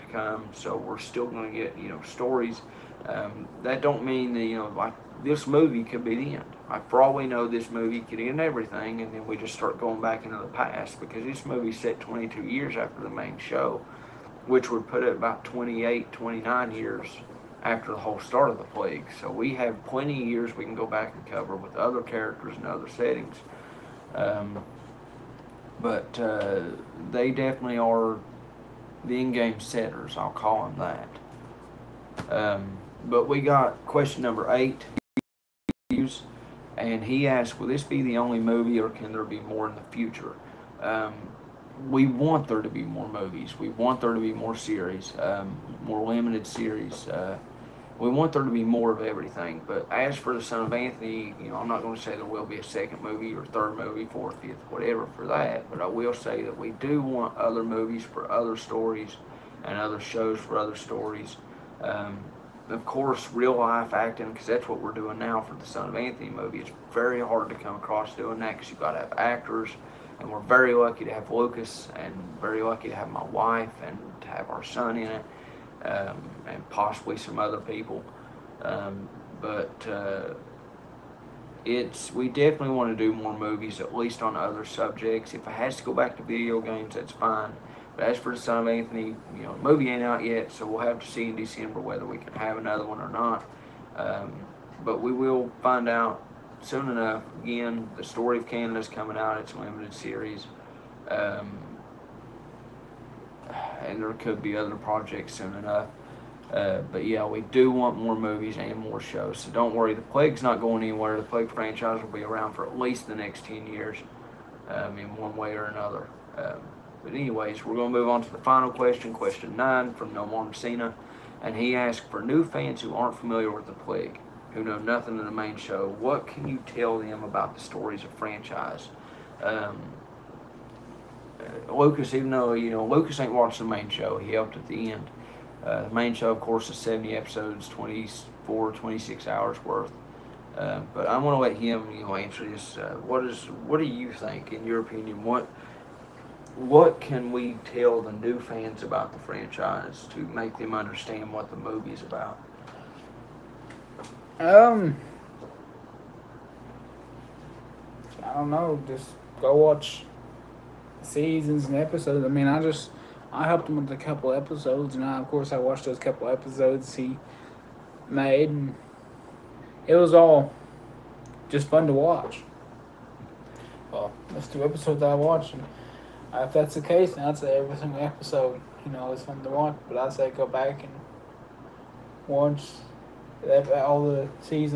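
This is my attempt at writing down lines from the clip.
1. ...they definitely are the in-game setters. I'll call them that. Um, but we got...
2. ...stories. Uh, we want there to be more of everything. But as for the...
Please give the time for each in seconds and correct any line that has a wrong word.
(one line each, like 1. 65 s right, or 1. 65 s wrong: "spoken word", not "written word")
1. 27 s right
2. 46 s wrong: "series", not "stories".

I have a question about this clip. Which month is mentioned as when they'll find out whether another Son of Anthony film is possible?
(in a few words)
December.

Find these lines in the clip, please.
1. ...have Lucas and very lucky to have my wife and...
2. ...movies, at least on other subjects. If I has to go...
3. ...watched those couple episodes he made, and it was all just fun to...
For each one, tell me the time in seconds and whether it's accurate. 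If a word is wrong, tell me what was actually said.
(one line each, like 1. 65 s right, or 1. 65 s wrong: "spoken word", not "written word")
1. 71 s right
2. 83 s right
3. 165 s right.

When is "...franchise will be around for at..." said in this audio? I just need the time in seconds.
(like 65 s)
111 s.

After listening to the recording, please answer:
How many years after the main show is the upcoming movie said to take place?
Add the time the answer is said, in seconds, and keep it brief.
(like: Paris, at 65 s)
22, at 12 s.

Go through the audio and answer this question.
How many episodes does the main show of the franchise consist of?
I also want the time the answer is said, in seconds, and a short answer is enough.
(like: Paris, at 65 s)
70, at 136 s.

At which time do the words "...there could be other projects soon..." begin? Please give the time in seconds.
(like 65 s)
104 s.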